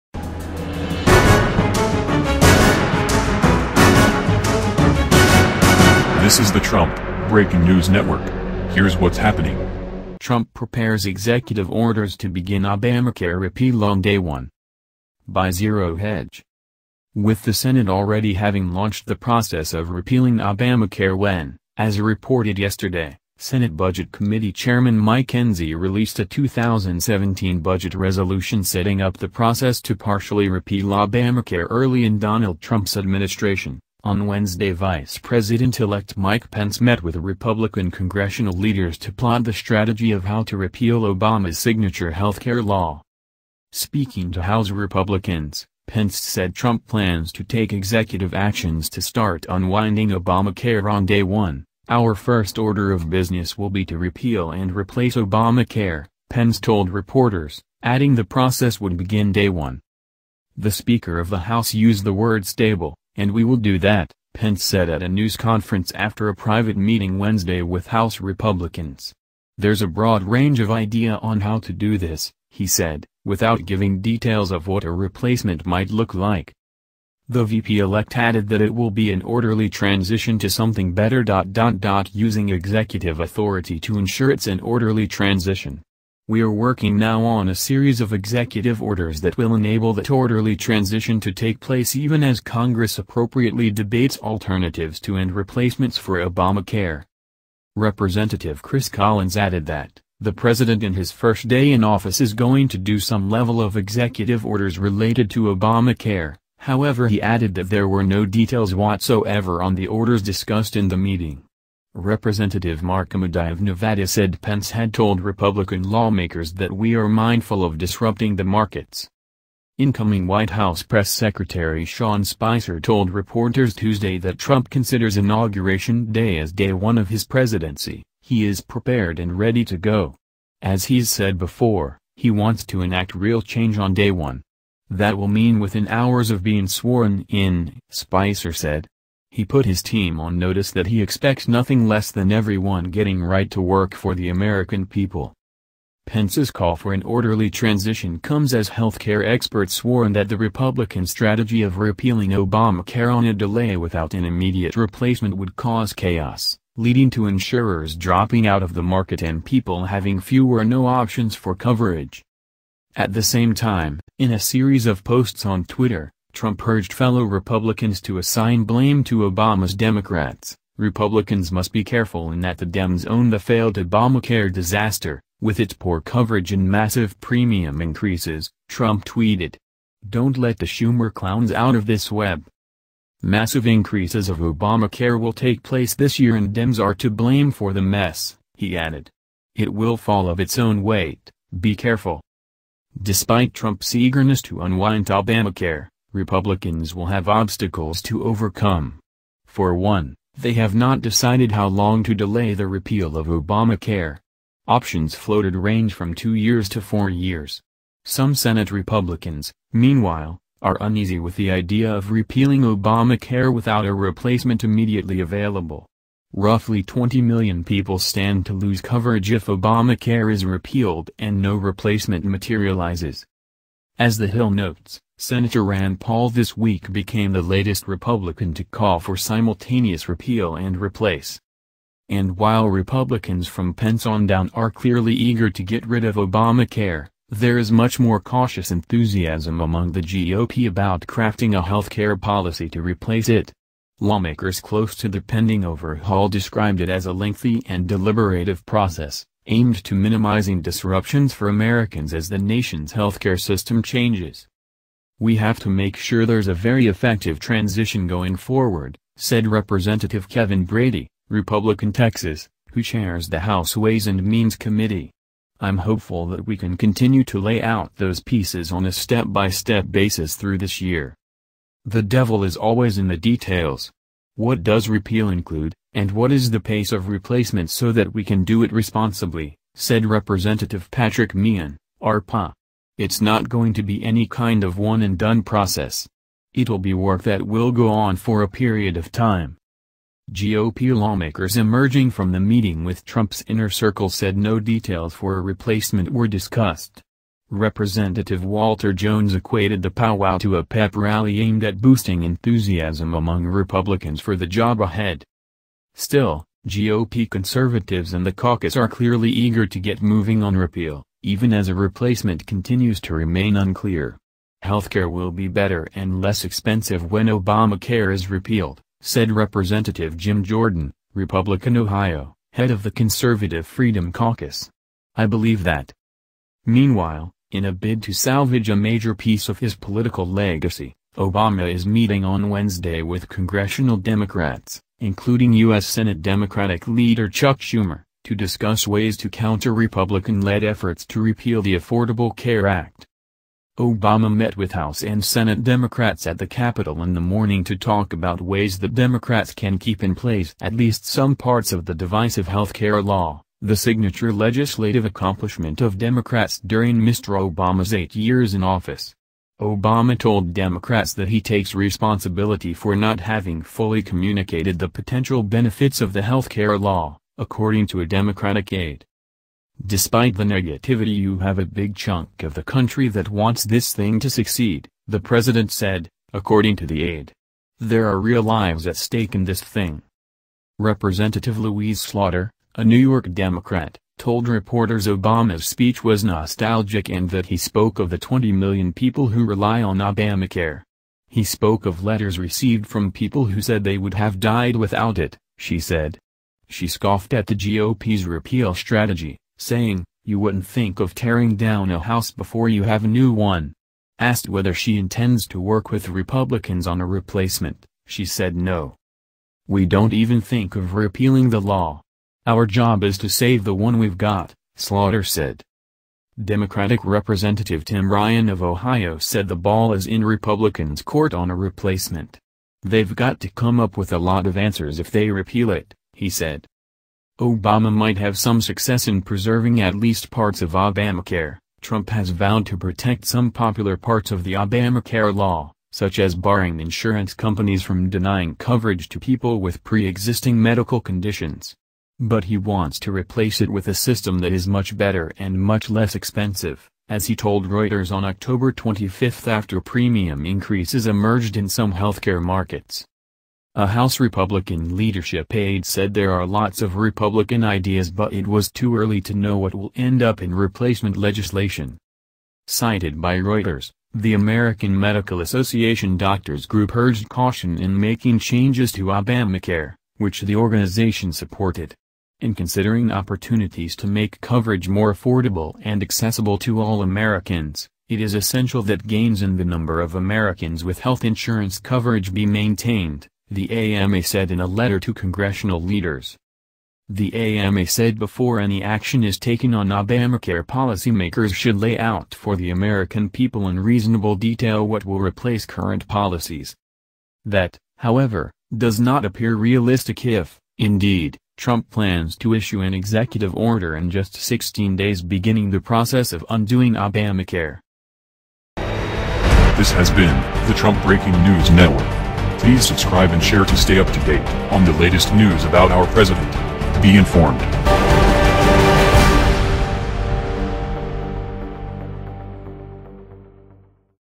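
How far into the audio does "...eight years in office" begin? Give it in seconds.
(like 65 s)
357 s.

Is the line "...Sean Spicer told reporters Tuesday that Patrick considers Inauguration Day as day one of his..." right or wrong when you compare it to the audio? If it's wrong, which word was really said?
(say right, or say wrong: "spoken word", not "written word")
wrong: "Trump", not "Patrick".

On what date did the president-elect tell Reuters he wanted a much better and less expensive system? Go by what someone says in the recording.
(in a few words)
October 25.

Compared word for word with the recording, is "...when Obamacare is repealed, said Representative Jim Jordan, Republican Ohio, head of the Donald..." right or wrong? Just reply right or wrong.
wrong.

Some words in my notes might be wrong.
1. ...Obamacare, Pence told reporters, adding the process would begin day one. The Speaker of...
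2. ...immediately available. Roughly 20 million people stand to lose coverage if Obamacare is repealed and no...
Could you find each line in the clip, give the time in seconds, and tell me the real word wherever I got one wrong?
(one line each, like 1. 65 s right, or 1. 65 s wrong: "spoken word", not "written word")
1. 55 s right
2. 214 s right.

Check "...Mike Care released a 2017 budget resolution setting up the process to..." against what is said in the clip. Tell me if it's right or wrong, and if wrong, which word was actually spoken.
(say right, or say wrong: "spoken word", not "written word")
wrong: "Enzi", not "Care".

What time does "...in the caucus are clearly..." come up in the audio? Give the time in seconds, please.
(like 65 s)
308 s.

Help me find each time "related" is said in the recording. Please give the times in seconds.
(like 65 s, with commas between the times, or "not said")
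104 s.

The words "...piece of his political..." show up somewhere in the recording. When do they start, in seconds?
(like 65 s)
329 s.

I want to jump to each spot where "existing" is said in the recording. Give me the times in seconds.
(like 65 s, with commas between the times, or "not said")
439 s.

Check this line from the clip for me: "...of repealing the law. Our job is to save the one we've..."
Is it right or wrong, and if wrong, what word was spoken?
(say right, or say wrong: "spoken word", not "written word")
right.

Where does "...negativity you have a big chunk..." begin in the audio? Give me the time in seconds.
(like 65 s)
370 s.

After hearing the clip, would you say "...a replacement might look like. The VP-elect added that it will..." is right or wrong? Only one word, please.
right.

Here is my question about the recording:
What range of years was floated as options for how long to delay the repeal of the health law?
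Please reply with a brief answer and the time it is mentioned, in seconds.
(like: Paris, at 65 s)
two years to four years, at 206 s.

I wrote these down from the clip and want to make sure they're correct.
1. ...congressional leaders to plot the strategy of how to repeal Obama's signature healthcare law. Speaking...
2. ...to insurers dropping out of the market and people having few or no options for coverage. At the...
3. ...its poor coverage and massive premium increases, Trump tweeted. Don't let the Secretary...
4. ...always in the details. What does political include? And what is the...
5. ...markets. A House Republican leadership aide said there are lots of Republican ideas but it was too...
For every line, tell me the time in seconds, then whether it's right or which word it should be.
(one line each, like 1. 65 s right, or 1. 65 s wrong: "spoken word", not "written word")
1. 37 s right
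2. 157 s right
3. 175 s wrong: "Schumer", not "Secretary"
4. 272 s wrong: "repeal", not "political"
5. 452 s right.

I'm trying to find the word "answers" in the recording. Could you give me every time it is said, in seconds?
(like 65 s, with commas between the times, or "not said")
424 s.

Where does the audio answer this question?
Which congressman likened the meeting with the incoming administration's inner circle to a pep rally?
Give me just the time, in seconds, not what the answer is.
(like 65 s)
298 s.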